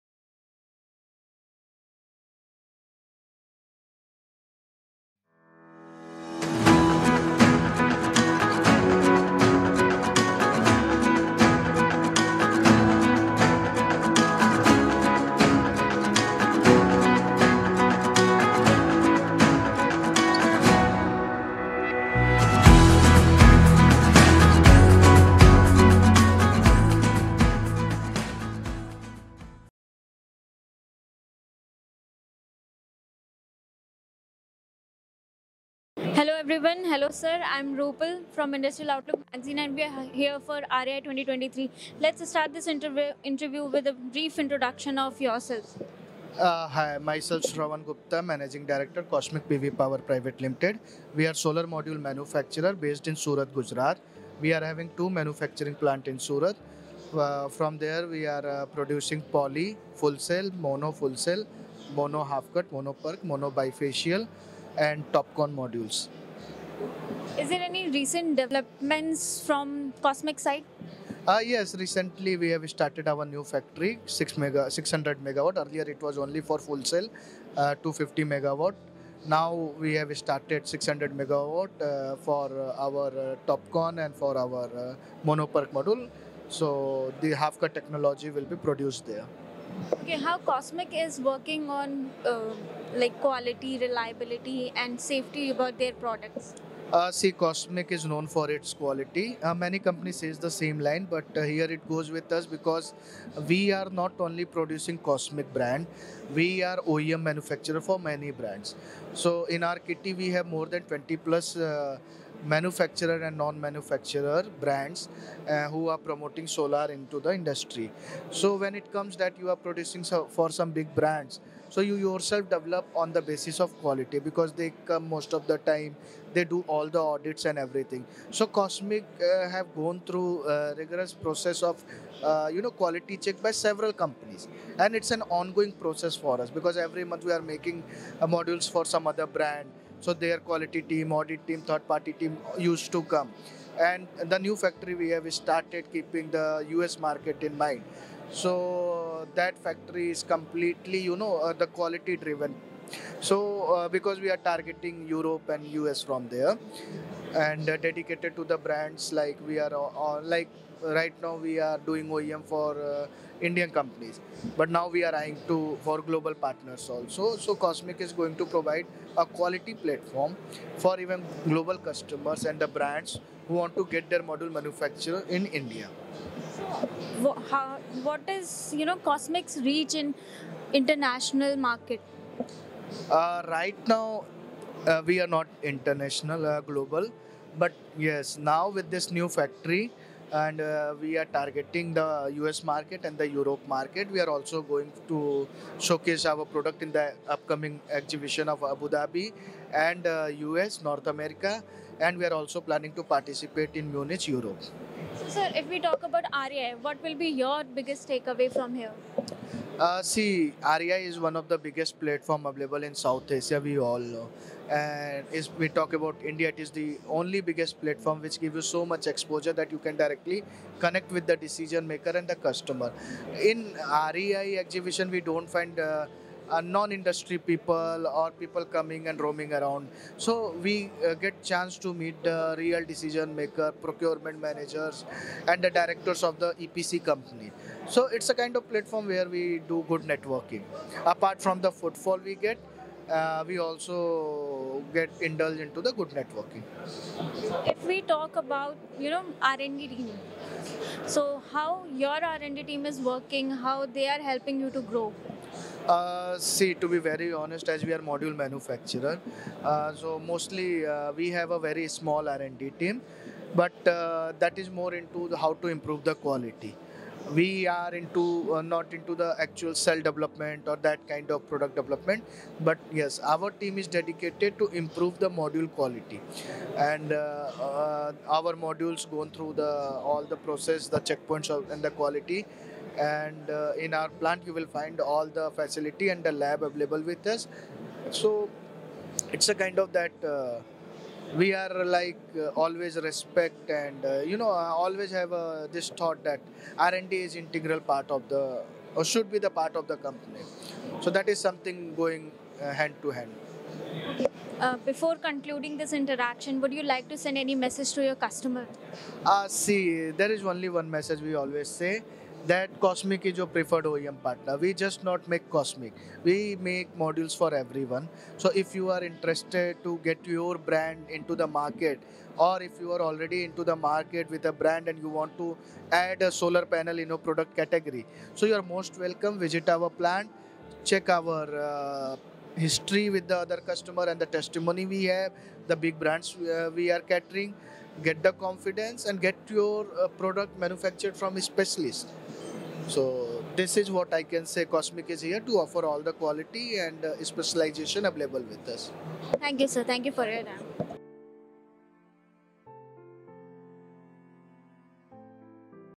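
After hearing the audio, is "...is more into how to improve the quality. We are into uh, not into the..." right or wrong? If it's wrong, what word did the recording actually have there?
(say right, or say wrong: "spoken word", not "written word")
right.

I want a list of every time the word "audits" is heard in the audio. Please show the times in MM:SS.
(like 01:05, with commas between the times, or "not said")
02:06, 02:21.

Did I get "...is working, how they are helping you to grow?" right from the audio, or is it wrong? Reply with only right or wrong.
right.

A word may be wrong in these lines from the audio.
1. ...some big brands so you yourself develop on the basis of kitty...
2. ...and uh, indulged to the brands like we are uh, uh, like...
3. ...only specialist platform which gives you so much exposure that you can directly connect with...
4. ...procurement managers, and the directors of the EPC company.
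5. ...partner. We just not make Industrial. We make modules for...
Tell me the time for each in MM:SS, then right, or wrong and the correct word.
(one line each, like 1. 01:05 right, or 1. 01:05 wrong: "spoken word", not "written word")
1. 02:00 wrong: "quality", not "kitty"
2. 02:37 wrong: "dedicated", not "indulged"
3. 03:37 wrong: "biggest", not "specialist"
4. 03:53 right
5. 05:14 wrong: "Cosmic", not "Industrial".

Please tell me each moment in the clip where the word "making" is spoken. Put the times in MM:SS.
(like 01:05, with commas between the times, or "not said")
02:17.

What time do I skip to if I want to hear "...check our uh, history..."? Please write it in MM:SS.
05:30.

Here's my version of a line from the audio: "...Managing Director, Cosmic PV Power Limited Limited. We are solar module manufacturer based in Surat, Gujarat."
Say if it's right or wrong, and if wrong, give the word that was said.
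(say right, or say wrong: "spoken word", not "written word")
wrong: "Private", not "Limited".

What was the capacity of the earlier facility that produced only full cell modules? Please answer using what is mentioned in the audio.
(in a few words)
250 megawatt.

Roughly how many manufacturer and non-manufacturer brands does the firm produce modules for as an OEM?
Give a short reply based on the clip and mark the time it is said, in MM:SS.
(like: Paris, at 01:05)
20 plus, at 01:50.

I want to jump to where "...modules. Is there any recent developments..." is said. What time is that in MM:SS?
01:05.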